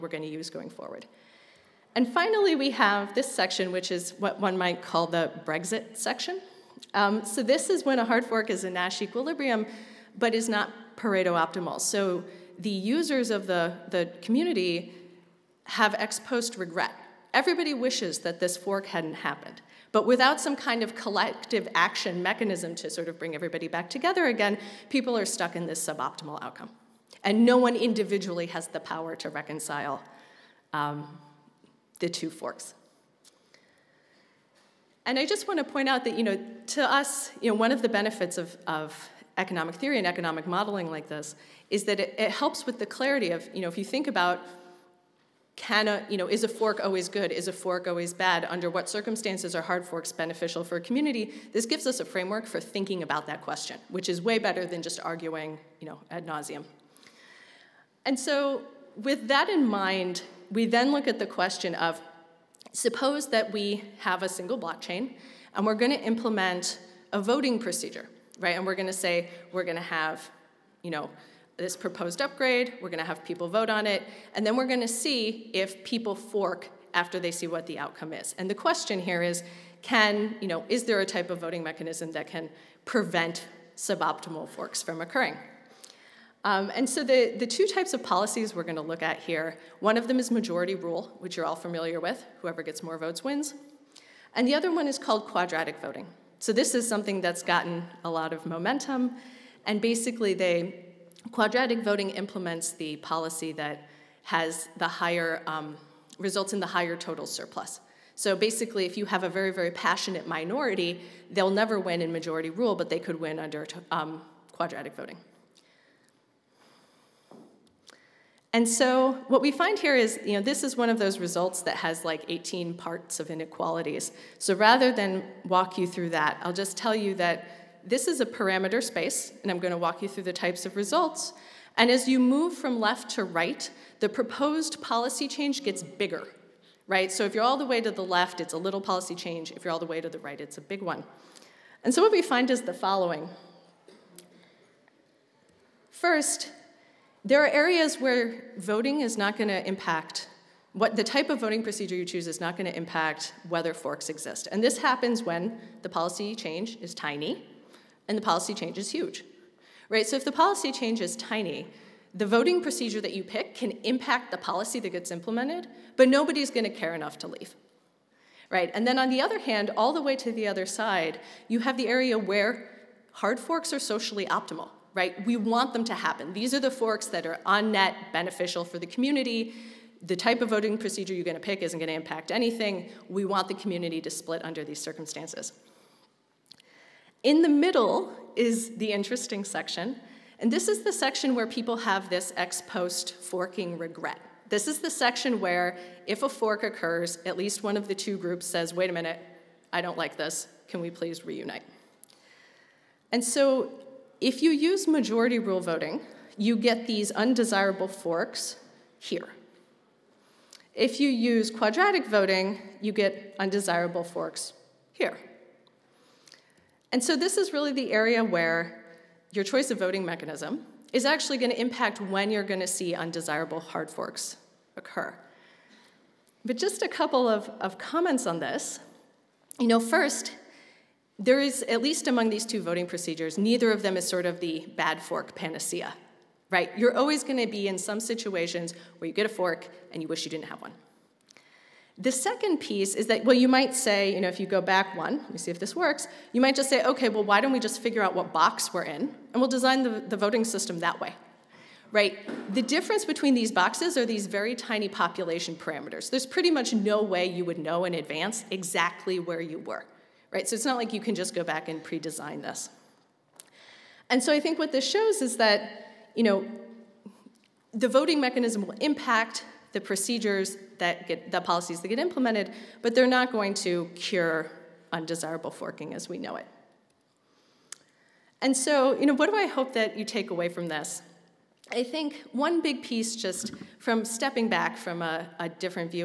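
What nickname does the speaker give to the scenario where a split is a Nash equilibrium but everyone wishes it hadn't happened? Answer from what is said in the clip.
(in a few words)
The Brexit section.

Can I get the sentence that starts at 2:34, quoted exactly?
And this happens when the policy change is tiny and the policy change is huge.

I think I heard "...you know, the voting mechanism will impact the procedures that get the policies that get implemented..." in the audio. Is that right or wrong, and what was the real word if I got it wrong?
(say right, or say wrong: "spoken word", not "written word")
right.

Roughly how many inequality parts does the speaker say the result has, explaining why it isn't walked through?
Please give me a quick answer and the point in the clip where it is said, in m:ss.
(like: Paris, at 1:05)
18, at 2:02.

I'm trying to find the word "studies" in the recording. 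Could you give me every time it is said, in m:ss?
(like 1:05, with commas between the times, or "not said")
not said.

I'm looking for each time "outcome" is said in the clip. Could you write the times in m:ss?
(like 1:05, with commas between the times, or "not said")
0:26, 1:17.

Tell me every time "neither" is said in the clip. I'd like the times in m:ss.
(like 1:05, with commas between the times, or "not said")
3:53.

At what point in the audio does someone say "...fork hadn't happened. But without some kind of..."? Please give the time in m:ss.
0:18.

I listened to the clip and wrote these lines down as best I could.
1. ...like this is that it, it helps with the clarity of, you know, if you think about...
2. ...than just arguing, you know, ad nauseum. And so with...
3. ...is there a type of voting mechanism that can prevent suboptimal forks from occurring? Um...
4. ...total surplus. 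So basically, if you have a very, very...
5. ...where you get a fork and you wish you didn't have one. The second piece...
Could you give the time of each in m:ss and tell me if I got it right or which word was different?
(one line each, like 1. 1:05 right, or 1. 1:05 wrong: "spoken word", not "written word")
1. 0:40 right
2. 0:54 right
3. 1:20 right
4. 1:46 right
5. 3:58 right.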